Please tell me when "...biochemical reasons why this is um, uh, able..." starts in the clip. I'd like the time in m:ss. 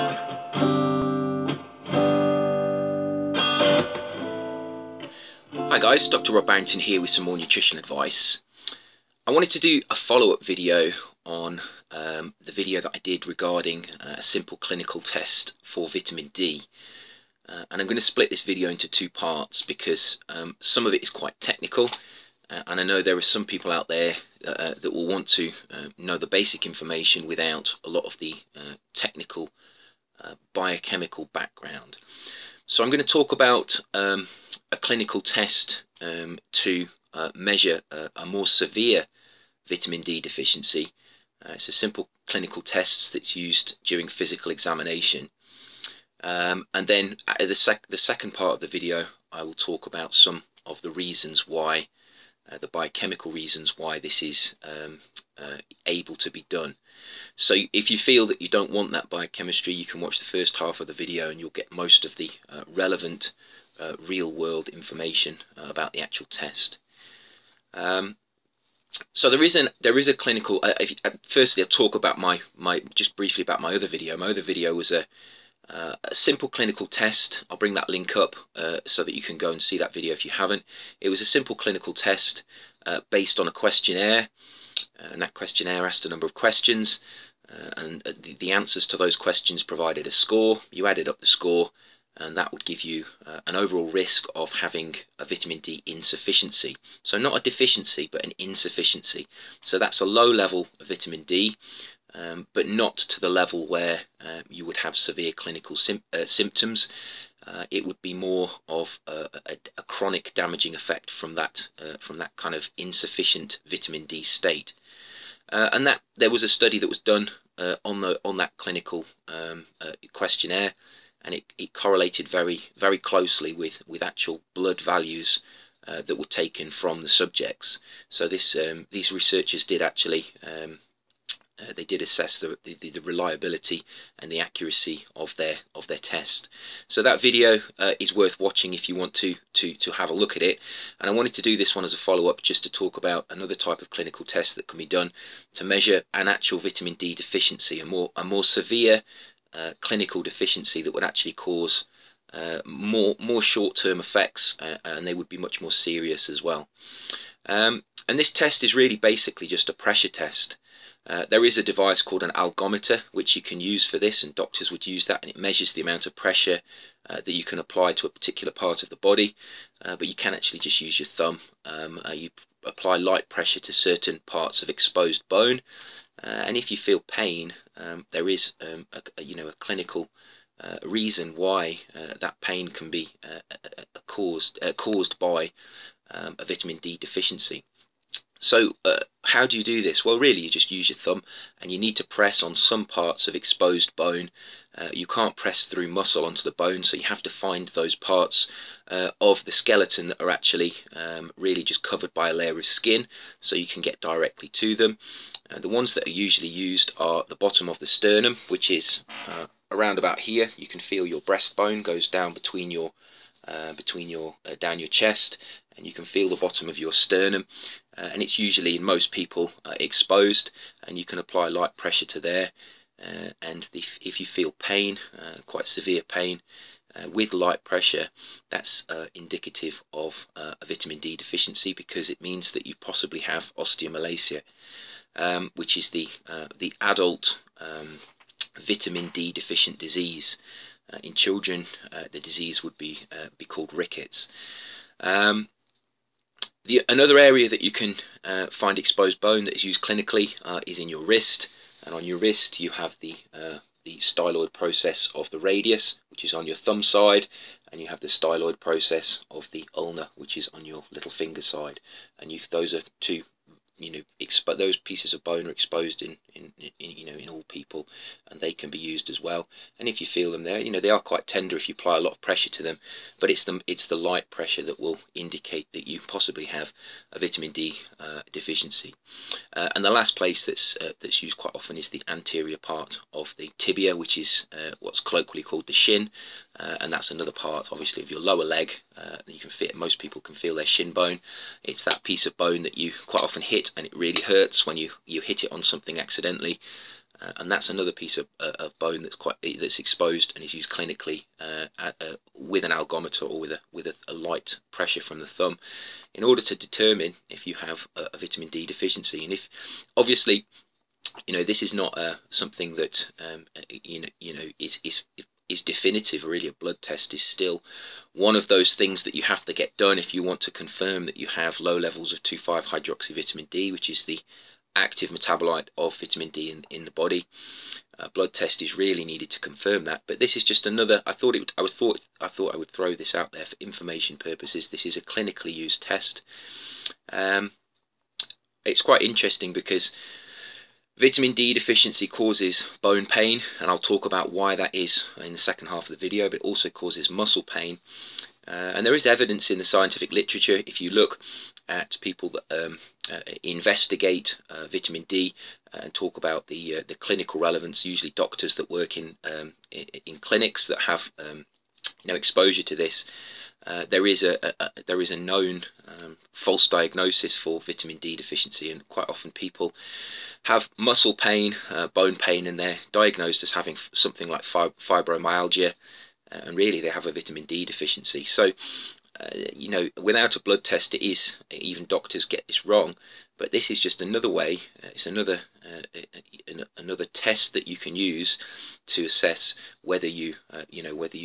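0:52.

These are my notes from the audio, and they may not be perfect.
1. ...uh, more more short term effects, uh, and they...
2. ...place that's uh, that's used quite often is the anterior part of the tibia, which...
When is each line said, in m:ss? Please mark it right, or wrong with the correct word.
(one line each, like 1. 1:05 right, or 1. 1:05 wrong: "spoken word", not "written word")
1. 2:32 right
2. 4:40 right.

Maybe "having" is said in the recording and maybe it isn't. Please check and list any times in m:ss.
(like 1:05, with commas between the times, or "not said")
1:34, 6:13.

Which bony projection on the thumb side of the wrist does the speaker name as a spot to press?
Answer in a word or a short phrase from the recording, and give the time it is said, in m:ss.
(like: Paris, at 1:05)
styloid process of the radius, at 4:13.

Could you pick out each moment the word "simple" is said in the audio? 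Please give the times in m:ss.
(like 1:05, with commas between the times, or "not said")
0:14, 0:41, 1:16, 1:21.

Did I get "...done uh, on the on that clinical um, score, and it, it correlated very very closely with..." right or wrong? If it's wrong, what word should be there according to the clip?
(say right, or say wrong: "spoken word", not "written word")
wrong: "questionnaire", not "score".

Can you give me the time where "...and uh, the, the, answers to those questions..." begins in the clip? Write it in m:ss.
1:27.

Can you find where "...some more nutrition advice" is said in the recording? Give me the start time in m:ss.
0:07.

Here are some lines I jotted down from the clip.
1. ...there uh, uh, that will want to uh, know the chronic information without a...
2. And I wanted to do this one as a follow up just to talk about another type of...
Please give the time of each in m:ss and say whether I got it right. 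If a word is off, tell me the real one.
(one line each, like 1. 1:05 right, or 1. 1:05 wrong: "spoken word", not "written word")
1. 0:23 wrong: "basic", not "chronic"
2. 2:20 right.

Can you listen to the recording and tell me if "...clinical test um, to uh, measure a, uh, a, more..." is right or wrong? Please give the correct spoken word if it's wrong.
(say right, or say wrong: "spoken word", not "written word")
right.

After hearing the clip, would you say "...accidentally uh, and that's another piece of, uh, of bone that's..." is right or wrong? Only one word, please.
right.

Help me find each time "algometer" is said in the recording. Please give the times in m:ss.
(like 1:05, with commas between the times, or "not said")
2:42, 5:02.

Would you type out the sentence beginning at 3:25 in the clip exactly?
Uh, the ones that are usually used are the bottom of the sternum, which is uh, around about here.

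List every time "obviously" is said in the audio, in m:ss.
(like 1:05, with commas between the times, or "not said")
4:47, 5:09.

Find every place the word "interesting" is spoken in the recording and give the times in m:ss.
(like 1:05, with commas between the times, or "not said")
5:39.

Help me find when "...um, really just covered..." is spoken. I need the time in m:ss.
3:20.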